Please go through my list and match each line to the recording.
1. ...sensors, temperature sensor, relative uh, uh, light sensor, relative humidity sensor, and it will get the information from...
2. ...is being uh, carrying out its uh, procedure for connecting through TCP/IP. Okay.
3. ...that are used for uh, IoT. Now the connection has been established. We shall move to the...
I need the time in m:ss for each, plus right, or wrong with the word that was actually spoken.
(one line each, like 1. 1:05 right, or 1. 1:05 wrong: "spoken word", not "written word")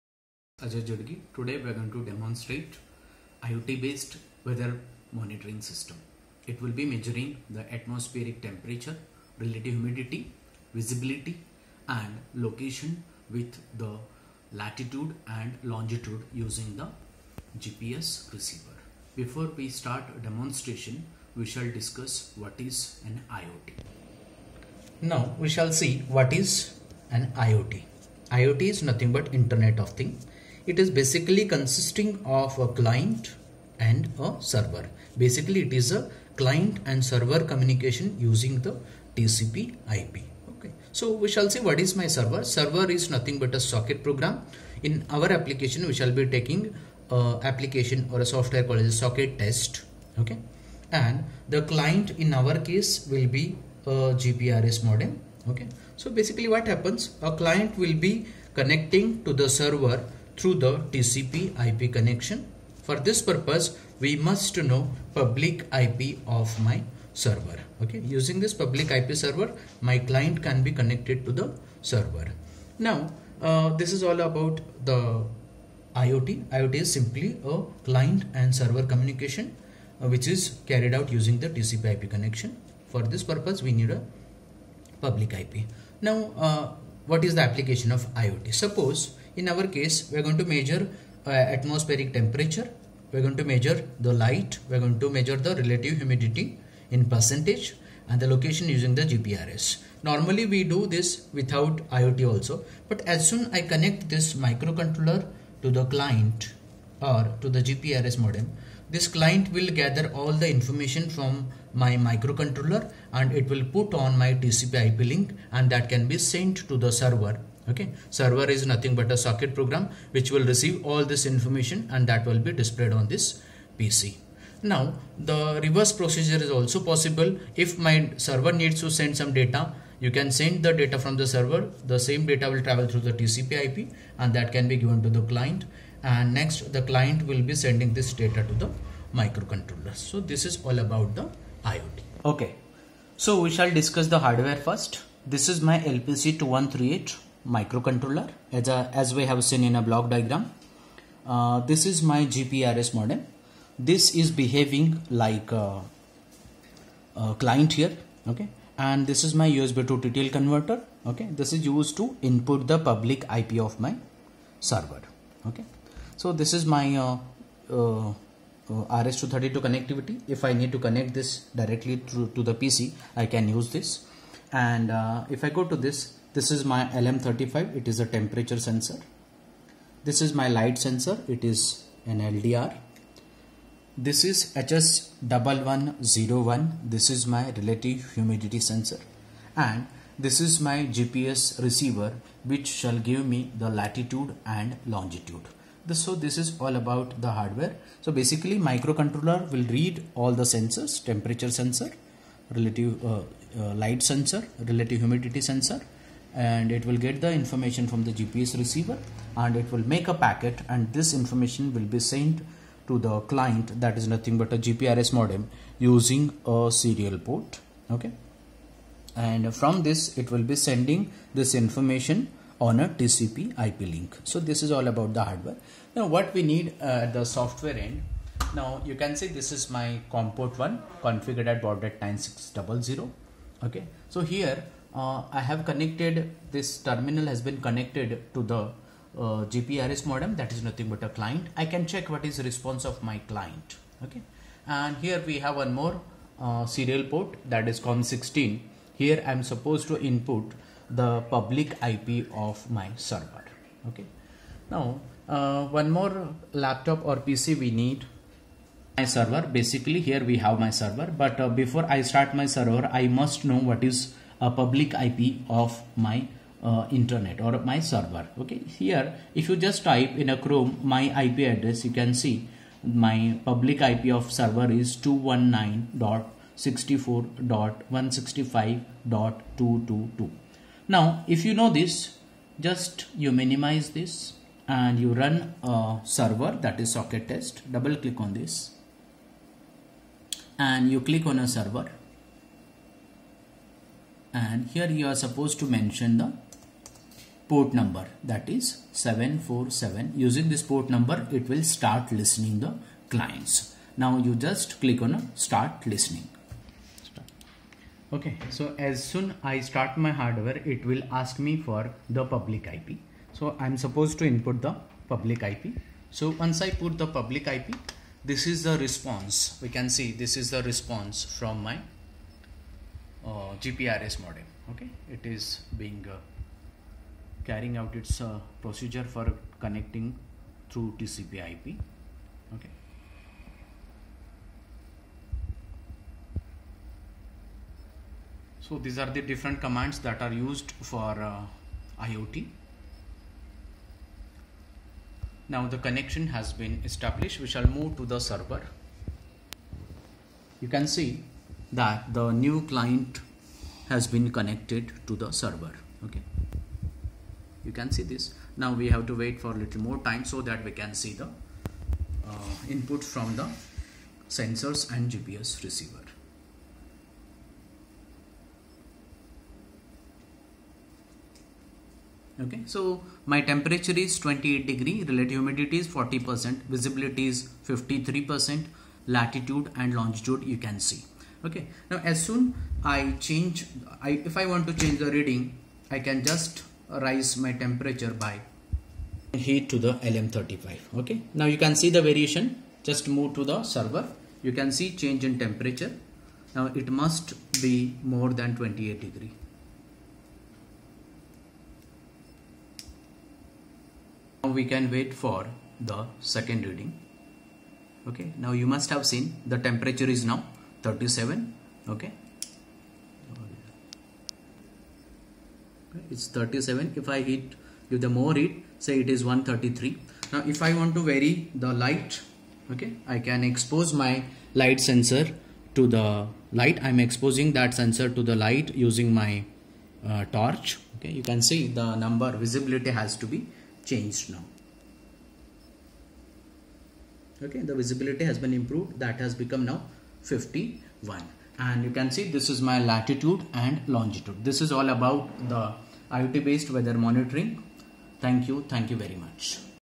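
1. 3:20 right
2. 5:25 right
3. 5:39 right.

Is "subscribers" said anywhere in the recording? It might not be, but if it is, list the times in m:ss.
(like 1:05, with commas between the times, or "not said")
not said.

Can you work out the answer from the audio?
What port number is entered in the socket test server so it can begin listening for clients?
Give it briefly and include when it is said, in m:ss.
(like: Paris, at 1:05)
747, at 4:58.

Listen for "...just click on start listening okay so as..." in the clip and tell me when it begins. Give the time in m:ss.
5:04.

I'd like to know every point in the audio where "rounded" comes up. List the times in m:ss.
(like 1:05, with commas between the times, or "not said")
not said.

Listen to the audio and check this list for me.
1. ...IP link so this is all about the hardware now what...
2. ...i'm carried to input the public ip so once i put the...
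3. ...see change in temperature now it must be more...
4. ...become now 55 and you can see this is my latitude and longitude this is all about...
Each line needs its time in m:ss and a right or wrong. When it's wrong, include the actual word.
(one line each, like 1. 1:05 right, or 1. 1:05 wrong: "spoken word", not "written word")
1. 3:43 right
2. 5:13 wrong: "supposed", not "carried"
3. 6:34 right
4. 7:19 wrong: "51", not "55".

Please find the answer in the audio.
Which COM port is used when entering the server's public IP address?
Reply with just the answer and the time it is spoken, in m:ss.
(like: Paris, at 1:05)
COM16, at 4:07.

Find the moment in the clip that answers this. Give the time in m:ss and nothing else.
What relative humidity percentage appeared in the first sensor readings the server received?
6:15.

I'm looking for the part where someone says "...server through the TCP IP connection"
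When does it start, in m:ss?
0:59.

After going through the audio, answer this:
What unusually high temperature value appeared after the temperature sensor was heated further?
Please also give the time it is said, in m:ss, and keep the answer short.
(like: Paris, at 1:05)
133, at 6:59.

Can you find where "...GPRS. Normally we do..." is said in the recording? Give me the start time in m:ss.
1:39.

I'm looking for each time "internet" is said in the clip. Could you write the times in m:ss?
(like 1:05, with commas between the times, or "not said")
0:29, 4:26.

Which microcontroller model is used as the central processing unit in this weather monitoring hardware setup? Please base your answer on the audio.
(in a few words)
LPC 2138.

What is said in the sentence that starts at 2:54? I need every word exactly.
And uh, if I go to this this is my LM35, it is a temperature sensor.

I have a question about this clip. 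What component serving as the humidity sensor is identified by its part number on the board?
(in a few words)
HS1101.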